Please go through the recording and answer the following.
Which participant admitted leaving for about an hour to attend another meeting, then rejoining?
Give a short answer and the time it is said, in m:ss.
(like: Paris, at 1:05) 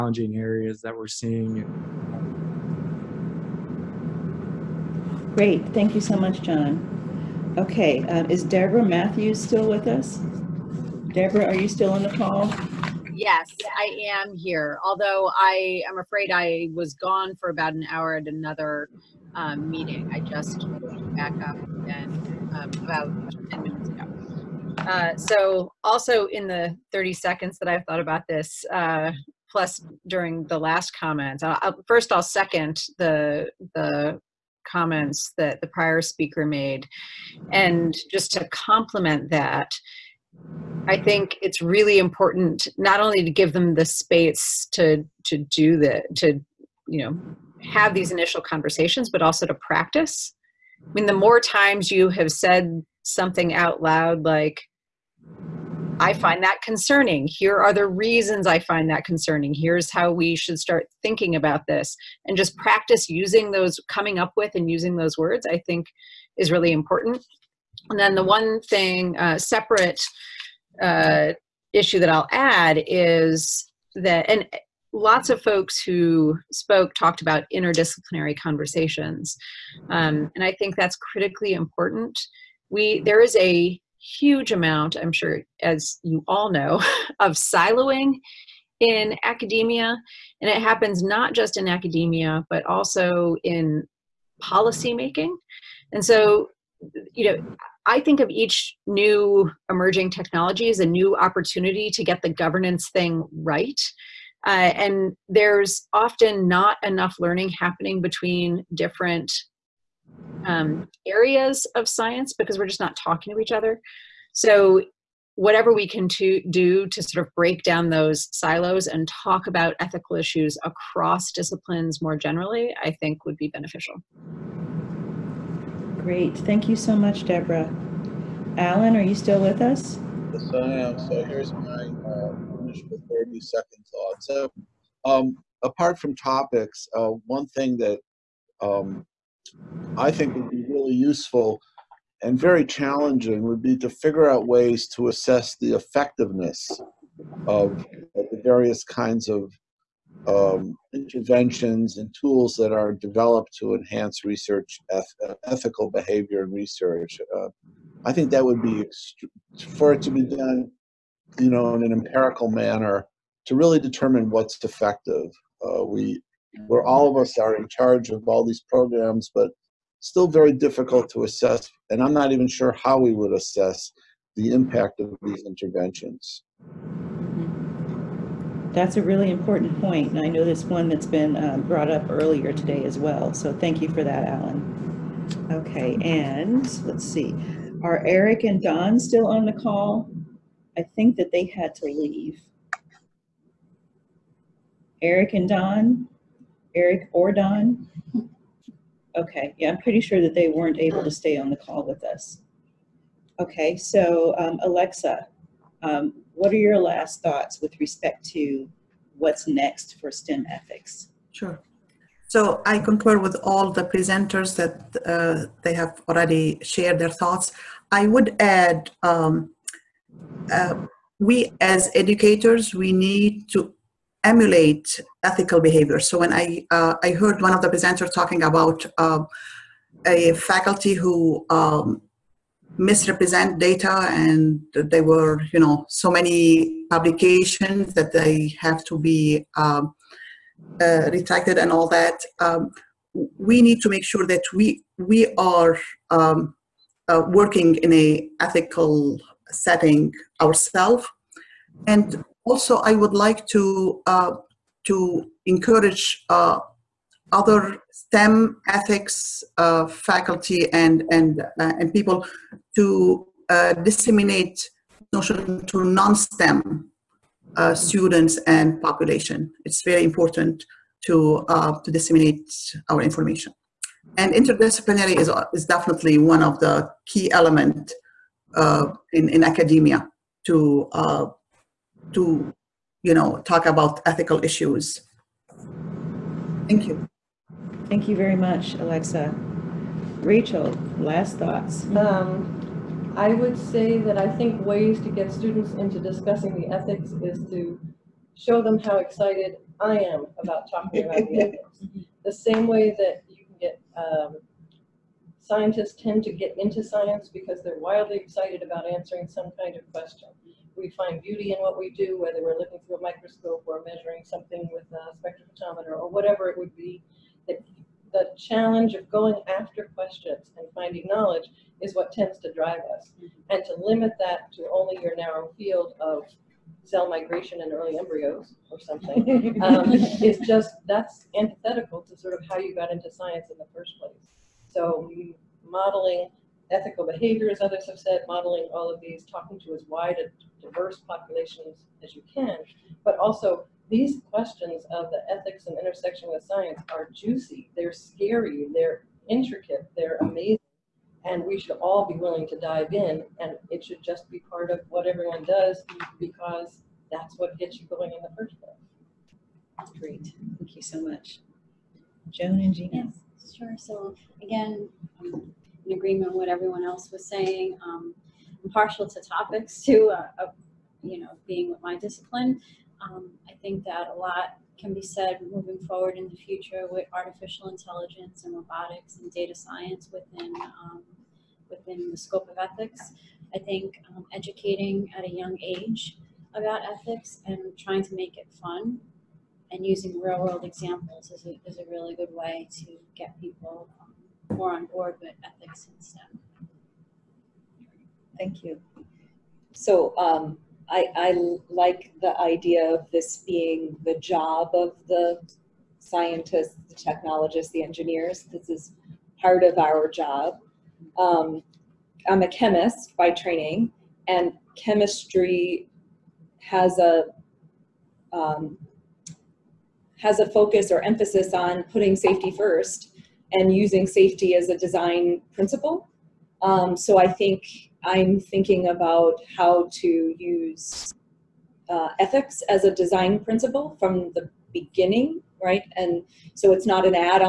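Deborah Matthews, at 0:08.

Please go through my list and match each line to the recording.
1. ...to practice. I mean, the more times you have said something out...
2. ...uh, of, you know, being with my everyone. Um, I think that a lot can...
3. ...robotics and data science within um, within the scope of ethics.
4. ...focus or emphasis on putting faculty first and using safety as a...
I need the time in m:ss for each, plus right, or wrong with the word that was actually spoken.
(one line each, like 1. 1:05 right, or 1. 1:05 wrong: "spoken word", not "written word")
1. 0:49 right
2. 6:10 wrong: "discipline", not "everyone"
3. 6:18 right
4. 7:00 wrong: "safety", not "faculty".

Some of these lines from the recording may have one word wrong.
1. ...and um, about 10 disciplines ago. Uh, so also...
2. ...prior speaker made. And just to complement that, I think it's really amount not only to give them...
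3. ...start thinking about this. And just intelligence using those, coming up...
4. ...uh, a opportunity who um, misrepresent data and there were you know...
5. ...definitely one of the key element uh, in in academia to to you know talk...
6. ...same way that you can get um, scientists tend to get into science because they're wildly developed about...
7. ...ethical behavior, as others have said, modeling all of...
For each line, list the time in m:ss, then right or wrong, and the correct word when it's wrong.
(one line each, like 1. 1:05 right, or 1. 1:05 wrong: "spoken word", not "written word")
1. 0:21 wrong: "minutes", not "disciplines"
2. 0:35 wrong: "important", not "amount"
3. 1:00 wrong: "practice", not "intelligence"
4. 3:48 wrong: "faculty", not "opportunity"
5. 4:35 right
6. 5:02 wrong: "excited", not "developed"
7. 5:36 right.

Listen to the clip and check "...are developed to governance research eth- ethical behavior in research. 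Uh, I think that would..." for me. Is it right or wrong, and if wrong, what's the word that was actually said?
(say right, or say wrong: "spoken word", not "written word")
wrong: "enhance", not "governance".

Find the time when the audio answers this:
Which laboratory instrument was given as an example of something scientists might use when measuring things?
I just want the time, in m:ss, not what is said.
5:15.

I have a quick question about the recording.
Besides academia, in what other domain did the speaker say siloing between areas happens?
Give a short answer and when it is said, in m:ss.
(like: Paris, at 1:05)
policymaking, at 1:34.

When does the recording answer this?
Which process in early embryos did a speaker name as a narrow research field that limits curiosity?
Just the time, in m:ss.
5:26.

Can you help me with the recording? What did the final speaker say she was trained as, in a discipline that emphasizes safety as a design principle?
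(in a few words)
chemist.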